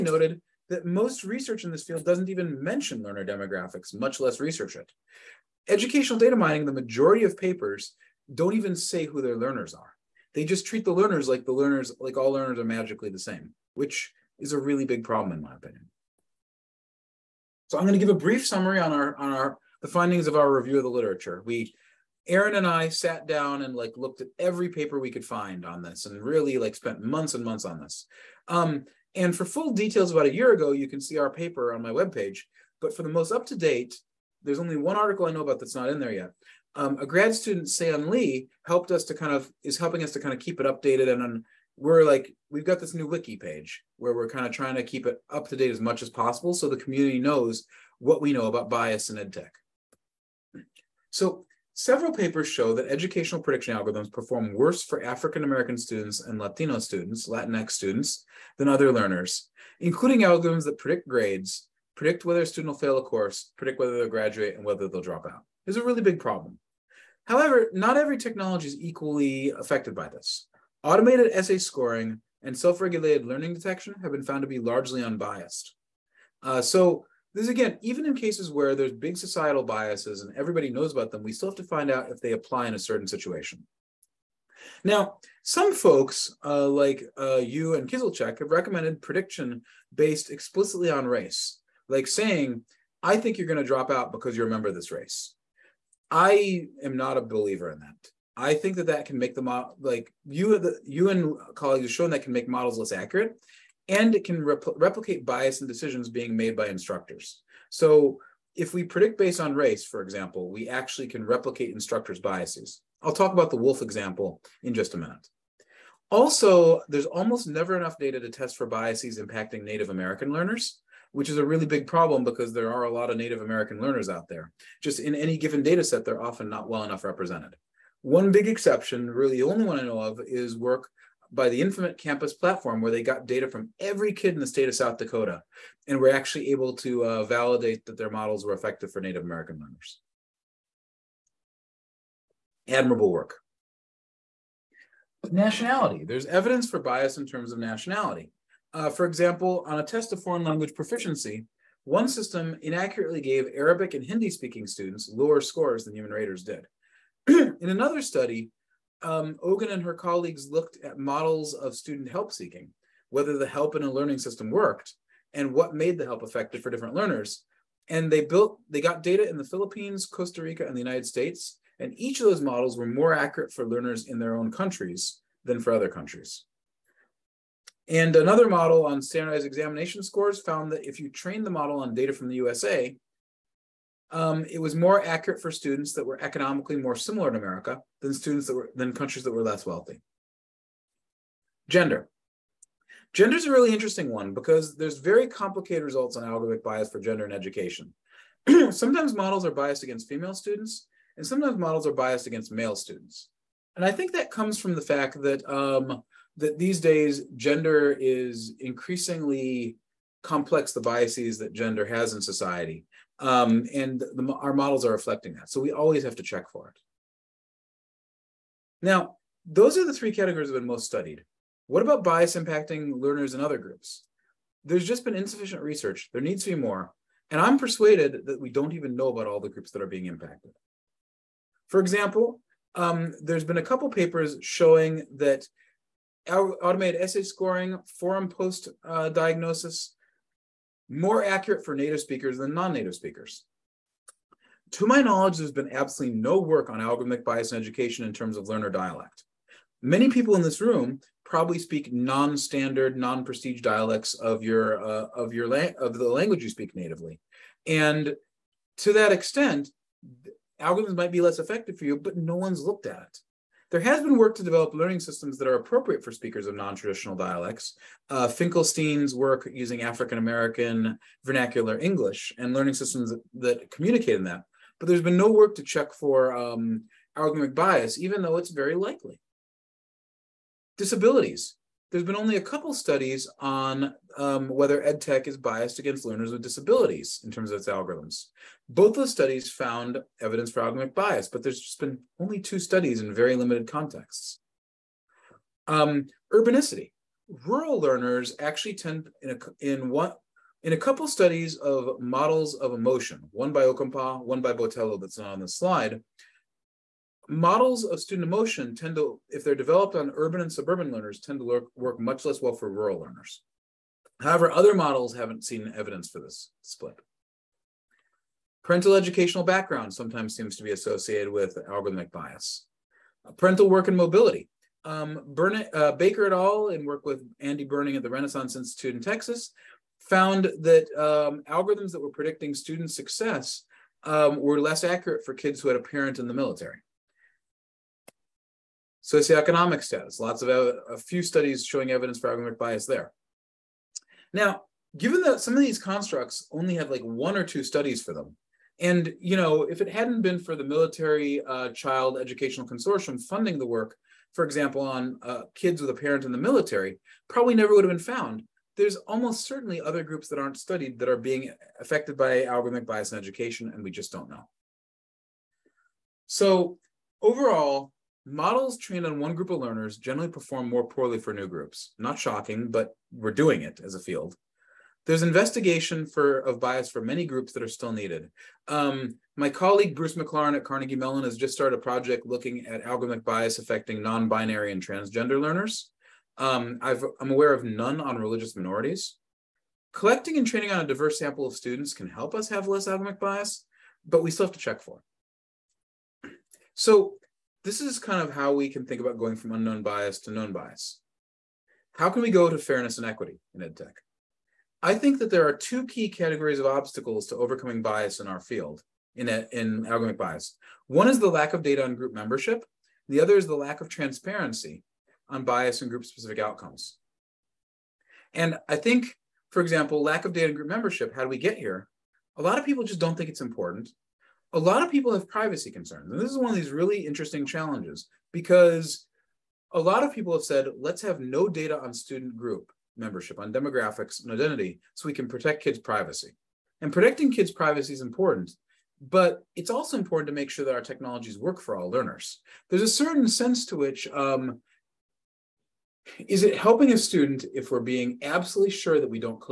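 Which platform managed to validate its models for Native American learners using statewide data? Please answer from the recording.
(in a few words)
Infinite Campus.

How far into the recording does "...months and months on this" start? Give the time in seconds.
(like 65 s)
27 s.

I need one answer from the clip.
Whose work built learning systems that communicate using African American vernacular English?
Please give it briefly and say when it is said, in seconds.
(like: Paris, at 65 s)
Finkelstein, at 268 s.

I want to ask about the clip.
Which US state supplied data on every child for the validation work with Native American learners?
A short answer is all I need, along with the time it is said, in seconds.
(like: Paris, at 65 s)
South Dakota, at 134 s.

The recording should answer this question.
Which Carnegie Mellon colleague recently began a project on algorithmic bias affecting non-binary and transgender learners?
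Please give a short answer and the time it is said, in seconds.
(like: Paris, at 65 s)
Bruce McLaren, at 379 s.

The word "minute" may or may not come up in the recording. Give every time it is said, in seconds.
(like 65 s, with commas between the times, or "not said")
114 s.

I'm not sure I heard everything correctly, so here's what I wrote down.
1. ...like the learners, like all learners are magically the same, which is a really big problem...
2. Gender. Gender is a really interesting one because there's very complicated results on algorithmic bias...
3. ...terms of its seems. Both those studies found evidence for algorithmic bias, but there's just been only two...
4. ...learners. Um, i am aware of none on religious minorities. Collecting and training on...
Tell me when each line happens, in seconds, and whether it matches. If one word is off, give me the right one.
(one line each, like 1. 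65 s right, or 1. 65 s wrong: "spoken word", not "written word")
1. 11 s right
2. 191 s right
3. 287 s wrong: "algorithms", not "seems"
4. 385 s right.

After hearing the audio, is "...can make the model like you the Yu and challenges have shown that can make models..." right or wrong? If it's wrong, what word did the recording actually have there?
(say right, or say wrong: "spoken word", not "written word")
wrong: "colleagues", not "challenges".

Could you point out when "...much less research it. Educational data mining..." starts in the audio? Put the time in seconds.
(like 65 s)
3 s.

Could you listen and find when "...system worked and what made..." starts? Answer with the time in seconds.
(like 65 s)
164 s.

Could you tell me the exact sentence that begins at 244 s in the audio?
To my knowledge, there's been absolutely no work on algorithmic bias in education in terms of learner dialect.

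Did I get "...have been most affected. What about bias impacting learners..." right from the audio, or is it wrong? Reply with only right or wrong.
wrong.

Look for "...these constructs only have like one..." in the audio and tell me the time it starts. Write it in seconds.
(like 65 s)
345 s.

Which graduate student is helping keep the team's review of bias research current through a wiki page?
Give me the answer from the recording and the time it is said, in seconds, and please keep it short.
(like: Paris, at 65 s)
Sam Lee, at 37 s.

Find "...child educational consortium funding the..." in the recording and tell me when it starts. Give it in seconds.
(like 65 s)
351 s.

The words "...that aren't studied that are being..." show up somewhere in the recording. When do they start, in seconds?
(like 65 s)
360 s.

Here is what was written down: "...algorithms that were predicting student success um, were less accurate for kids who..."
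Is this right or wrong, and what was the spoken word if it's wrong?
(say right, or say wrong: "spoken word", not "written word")
right.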